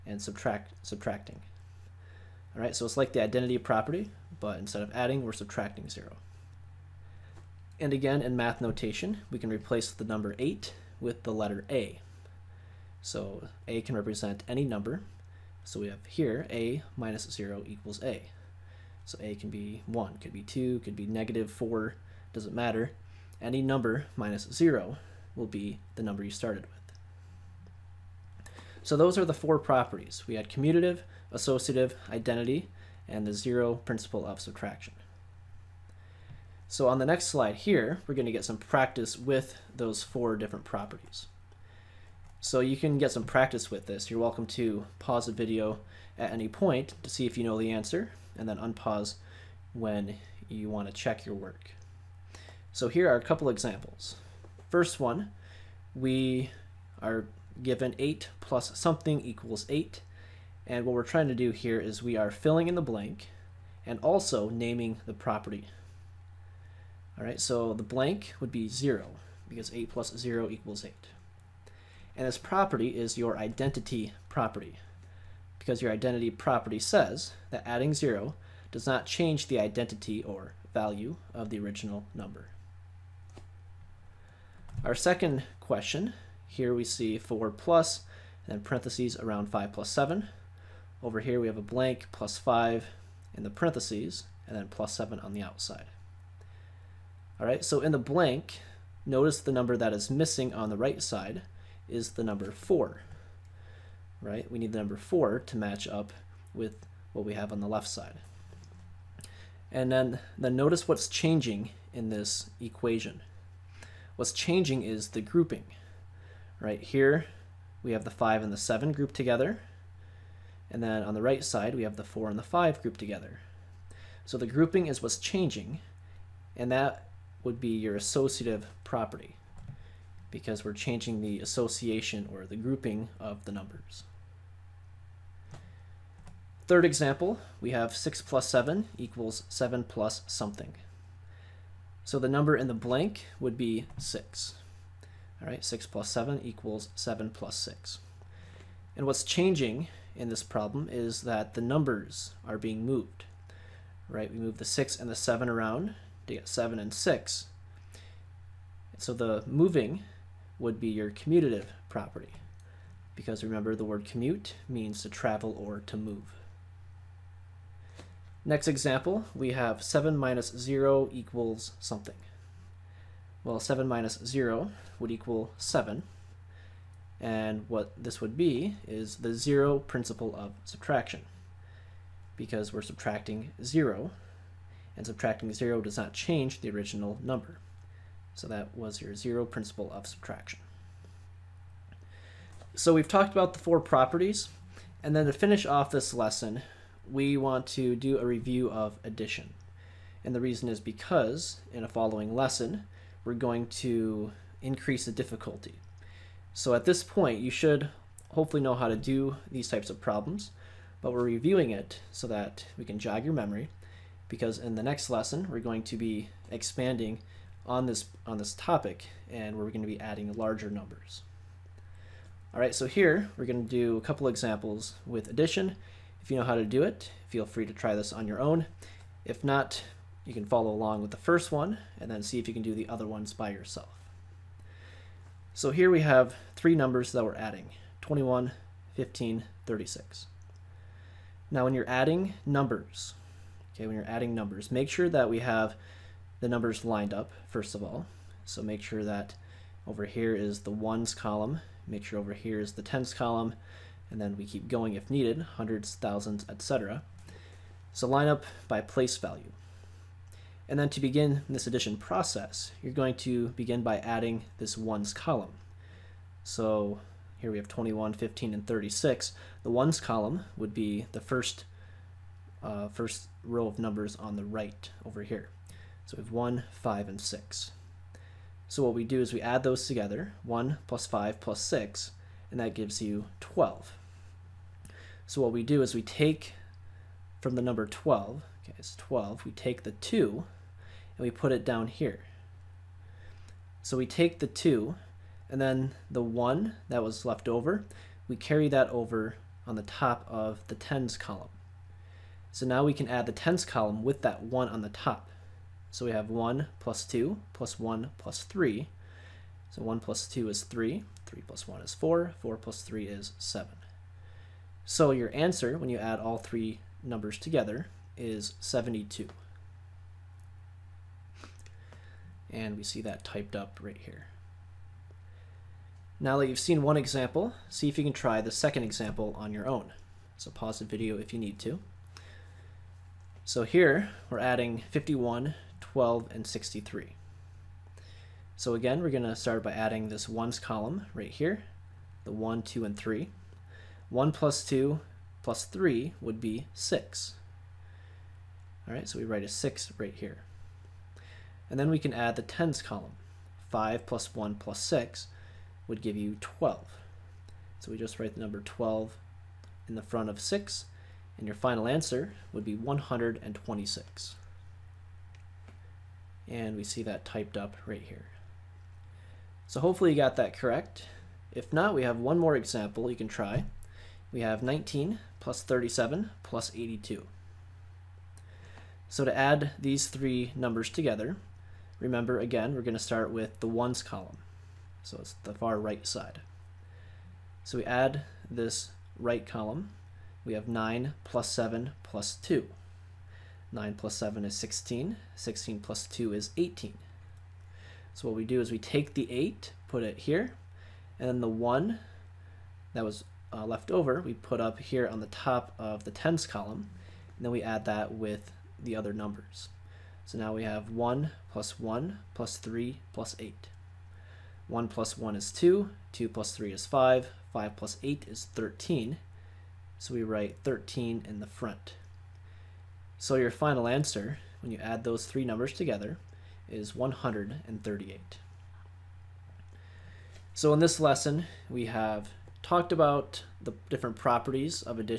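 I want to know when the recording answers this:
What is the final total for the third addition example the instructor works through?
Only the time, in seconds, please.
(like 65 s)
426 s.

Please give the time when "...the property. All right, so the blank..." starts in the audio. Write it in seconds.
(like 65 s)
65 s.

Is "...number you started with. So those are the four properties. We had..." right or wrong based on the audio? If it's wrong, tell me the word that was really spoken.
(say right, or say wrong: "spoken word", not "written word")
right.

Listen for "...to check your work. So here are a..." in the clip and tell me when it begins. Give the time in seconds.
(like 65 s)
50 s.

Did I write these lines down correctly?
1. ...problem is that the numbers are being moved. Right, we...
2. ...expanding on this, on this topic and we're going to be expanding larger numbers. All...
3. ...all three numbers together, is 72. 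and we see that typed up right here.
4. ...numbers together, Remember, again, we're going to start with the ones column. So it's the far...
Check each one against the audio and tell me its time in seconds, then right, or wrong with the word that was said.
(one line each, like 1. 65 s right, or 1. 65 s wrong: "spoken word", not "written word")
1. 150 s right
2. 216 s wrong: "adding", not "expanding"
3. 316 s right
4. 380 s right.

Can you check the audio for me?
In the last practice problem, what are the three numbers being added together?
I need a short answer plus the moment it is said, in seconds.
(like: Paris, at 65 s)
19, 37, 82, at 374 s.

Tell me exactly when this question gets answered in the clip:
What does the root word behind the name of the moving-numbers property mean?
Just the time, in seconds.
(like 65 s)
165 s.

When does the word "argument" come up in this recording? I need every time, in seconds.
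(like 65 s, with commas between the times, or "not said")
not said.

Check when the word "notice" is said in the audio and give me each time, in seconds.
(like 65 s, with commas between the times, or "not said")
99 s, 110 s.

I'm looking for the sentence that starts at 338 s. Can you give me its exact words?
So again, we're going to start by adding this ones column right here, the 1, 2, and 3.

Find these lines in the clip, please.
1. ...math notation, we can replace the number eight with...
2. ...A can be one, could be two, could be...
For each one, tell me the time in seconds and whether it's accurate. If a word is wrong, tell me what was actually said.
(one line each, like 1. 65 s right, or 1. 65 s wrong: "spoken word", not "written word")
1. 8 s right
2. 19 s right.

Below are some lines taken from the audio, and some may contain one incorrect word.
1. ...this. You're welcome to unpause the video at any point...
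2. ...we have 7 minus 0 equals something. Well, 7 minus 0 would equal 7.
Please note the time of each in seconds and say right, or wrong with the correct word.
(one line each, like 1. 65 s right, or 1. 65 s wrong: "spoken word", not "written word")
1. 43 s wrong: "pause", not "unpause"
2. 169 s right.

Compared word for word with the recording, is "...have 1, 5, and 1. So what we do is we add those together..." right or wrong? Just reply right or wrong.
wrong.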